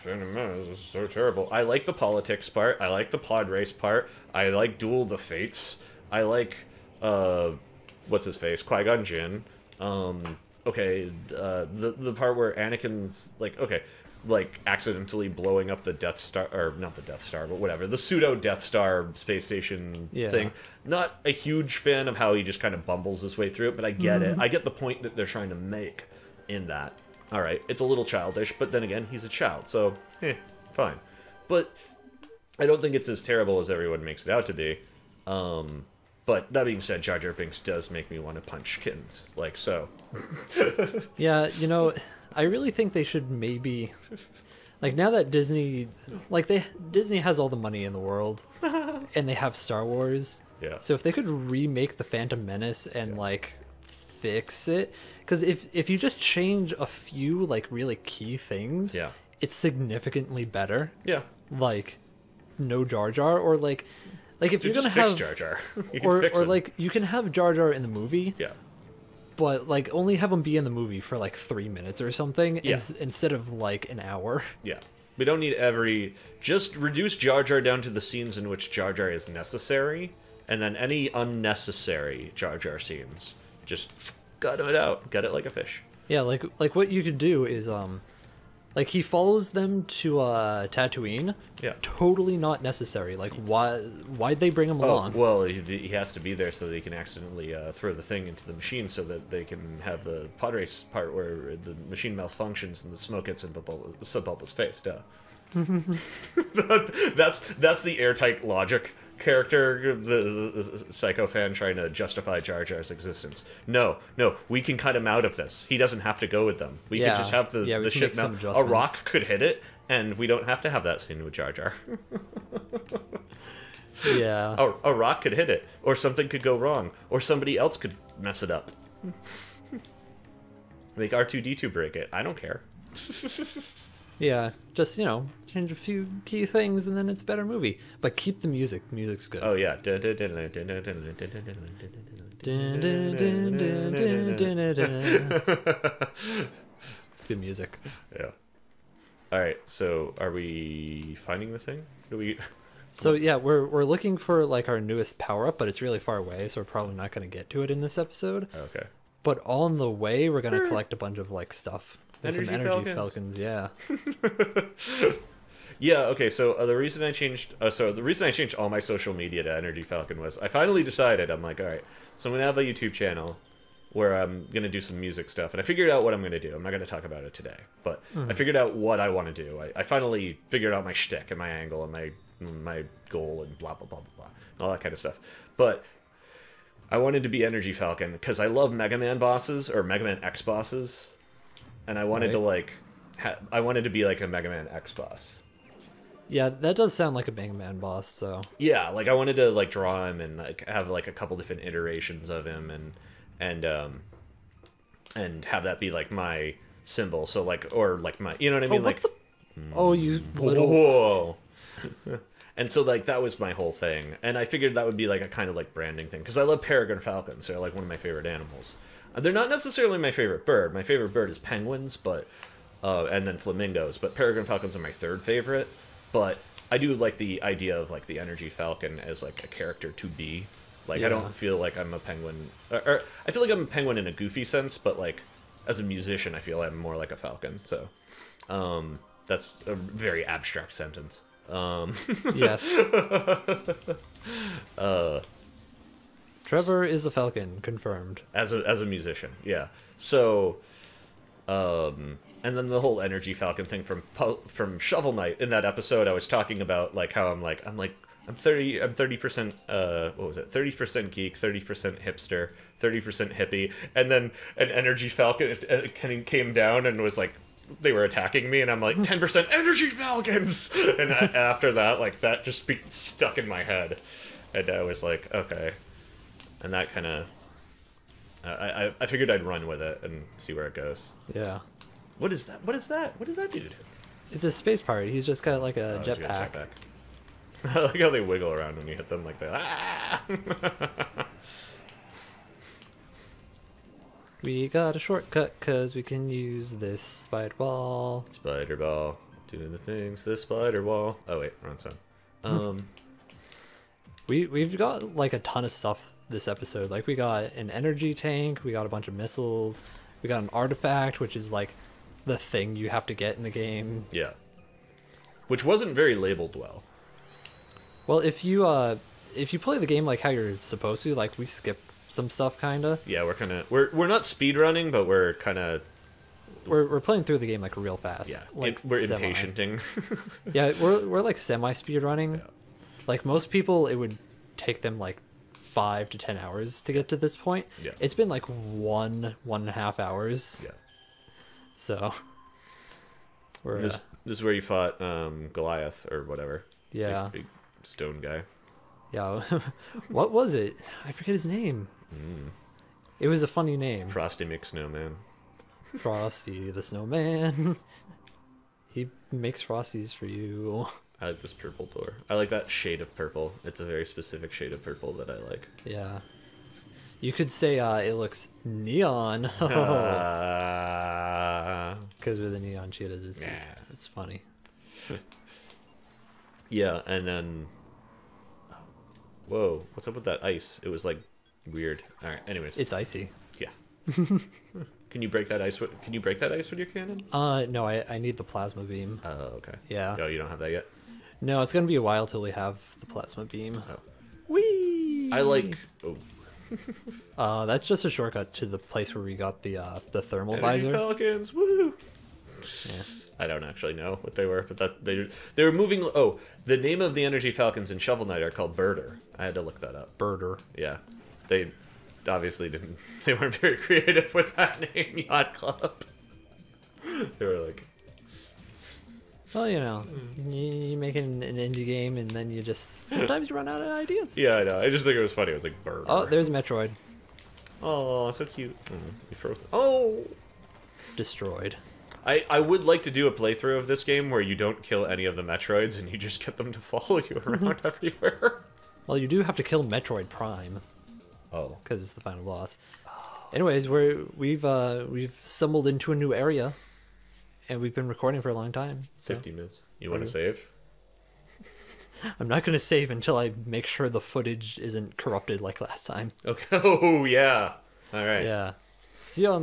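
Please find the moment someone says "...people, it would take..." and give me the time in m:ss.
5:33.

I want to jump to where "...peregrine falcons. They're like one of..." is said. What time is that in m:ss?
3:36.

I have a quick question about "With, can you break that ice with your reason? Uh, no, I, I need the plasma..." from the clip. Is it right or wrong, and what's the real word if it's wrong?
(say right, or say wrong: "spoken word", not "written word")
wrong: "cannon", not "reason".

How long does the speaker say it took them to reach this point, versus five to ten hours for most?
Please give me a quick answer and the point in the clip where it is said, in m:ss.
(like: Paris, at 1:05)
1.5 hours, at 5:38.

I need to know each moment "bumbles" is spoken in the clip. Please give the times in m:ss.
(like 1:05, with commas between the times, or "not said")
0:22.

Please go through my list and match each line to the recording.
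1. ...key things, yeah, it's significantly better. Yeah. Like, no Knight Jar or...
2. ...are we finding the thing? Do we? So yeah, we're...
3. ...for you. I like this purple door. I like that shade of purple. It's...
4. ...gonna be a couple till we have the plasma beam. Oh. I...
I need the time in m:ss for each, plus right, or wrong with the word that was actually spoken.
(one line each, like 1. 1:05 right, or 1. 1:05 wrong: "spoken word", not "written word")
1. 0:58 wrong: "Jar", not "Knight"
2. 2:30 right
3. 6:00 right
4. 6:31 wrong: "while", not "couple".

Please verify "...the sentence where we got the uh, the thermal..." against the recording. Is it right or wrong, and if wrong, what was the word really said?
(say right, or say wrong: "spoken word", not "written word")
wrong: "place", not "sentence".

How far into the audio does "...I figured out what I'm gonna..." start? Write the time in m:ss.
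2:55.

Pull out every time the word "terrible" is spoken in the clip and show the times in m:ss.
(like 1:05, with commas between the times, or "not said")
0:01, 0:33.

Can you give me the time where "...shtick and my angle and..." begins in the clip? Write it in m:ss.
3:00.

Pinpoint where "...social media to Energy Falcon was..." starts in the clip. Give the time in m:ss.
2:48.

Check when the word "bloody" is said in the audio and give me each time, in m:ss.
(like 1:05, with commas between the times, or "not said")
not said.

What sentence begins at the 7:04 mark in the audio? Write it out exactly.
I just think it was funny.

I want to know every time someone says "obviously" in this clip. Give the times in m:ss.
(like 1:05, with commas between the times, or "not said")
6:52.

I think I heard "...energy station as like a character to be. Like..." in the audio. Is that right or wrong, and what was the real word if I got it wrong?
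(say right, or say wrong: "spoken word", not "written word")
wrong: "falcon", not "station".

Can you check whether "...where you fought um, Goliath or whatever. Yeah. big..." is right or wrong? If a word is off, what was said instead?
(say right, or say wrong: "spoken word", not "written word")
right.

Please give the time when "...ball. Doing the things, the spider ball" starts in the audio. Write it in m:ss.
4:58.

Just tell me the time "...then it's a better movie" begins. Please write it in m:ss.
2:16.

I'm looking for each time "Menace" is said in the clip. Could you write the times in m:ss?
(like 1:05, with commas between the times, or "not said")
0:00, 0:52.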